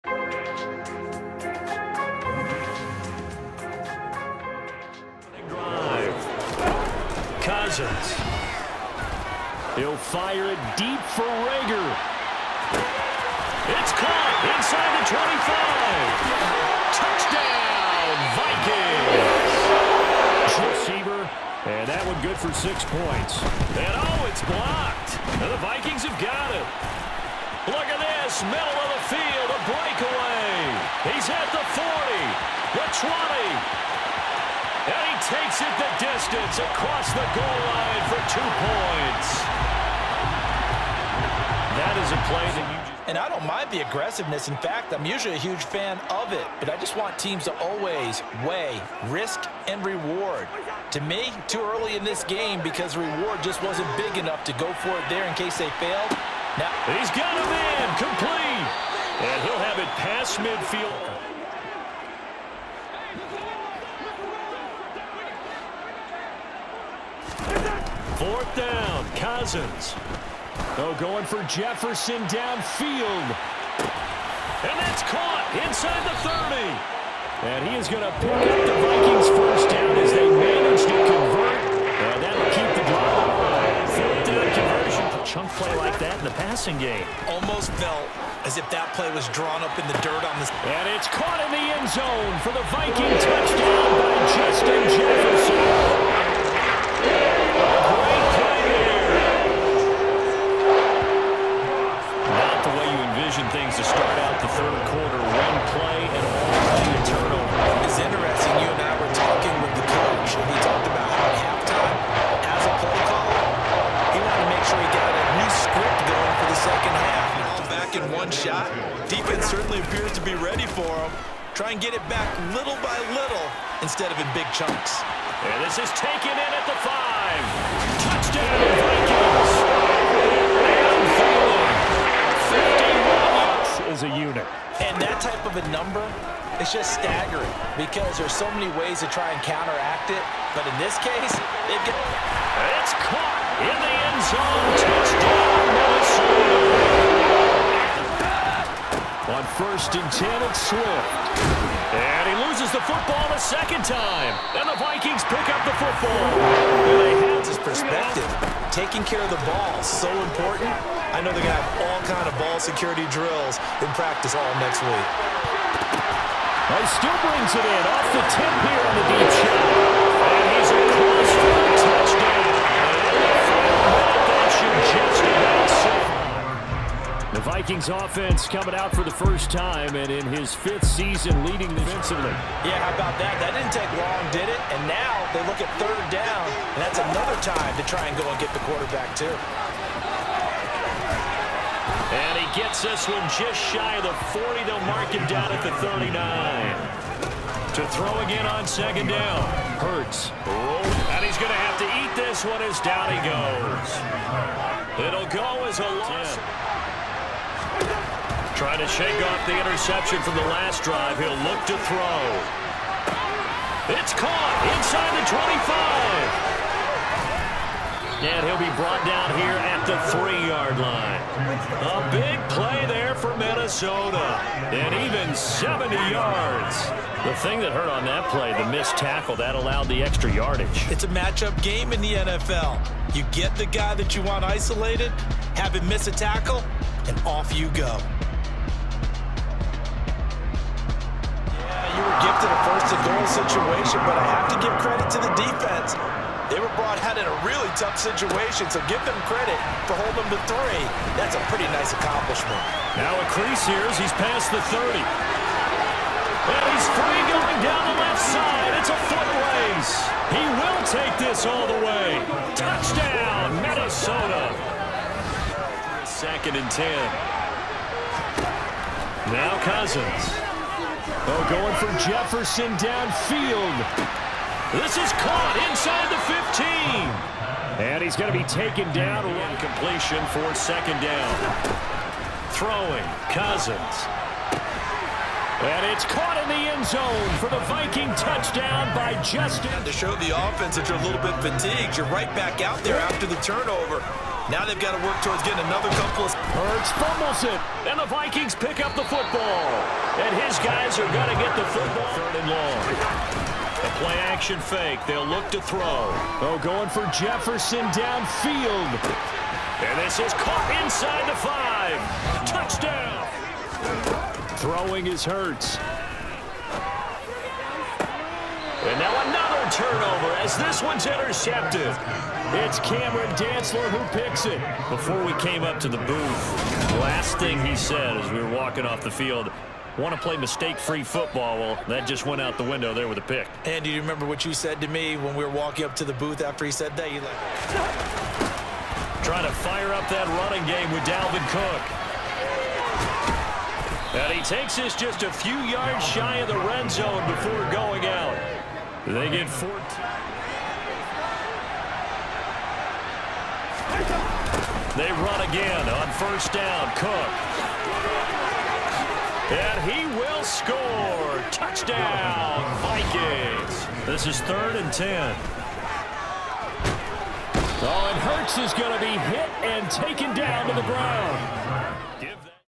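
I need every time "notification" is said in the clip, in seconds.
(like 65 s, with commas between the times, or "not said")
not said.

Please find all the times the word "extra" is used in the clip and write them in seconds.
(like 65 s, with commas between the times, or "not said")
230 s.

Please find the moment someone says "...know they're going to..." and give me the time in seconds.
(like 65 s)
161 s.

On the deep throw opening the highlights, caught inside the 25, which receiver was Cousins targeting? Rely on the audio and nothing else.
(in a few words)
Reagor.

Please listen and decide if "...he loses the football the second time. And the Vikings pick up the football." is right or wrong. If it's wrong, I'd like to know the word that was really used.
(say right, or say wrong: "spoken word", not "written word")
right.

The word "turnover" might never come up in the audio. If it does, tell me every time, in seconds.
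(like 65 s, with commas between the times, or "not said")
293 s, 319 s.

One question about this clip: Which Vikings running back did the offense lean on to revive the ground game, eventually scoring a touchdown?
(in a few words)
Dalvin Cook.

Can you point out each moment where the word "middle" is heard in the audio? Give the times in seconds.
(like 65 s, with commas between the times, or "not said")
28 s.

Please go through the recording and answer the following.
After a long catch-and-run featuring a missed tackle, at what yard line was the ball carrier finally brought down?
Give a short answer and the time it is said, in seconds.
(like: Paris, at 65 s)
3, at 220 s.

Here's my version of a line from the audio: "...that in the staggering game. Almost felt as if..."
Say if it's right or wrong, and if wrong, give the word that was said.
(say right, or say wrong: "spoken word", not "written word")
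wrong: "passing", not "staggering".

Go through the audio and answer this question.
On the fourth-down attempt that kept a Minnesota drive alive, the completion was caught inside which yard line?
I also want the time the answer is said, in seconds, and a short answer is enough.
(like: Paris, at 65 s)
30, at 75 s.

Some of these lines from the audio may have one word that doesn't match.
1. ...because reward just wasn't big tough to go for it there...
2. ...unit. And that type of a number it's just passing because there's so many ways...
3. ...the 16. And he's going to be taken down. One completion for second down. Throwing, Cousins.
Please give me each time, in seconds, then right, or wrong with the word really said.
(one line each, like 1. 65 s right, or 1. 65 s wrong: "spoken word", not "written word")
1. 52 s wrong: "enough", not "tough"
2. 134 s wrong: "staggering", not "passing"
3. 276 s wrong: "15", not "16".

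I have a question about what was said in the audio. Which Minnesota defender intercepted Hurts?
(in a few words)
Cameron Dantzler.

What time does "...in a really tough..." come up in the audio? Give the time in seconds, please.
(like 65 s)
247 s.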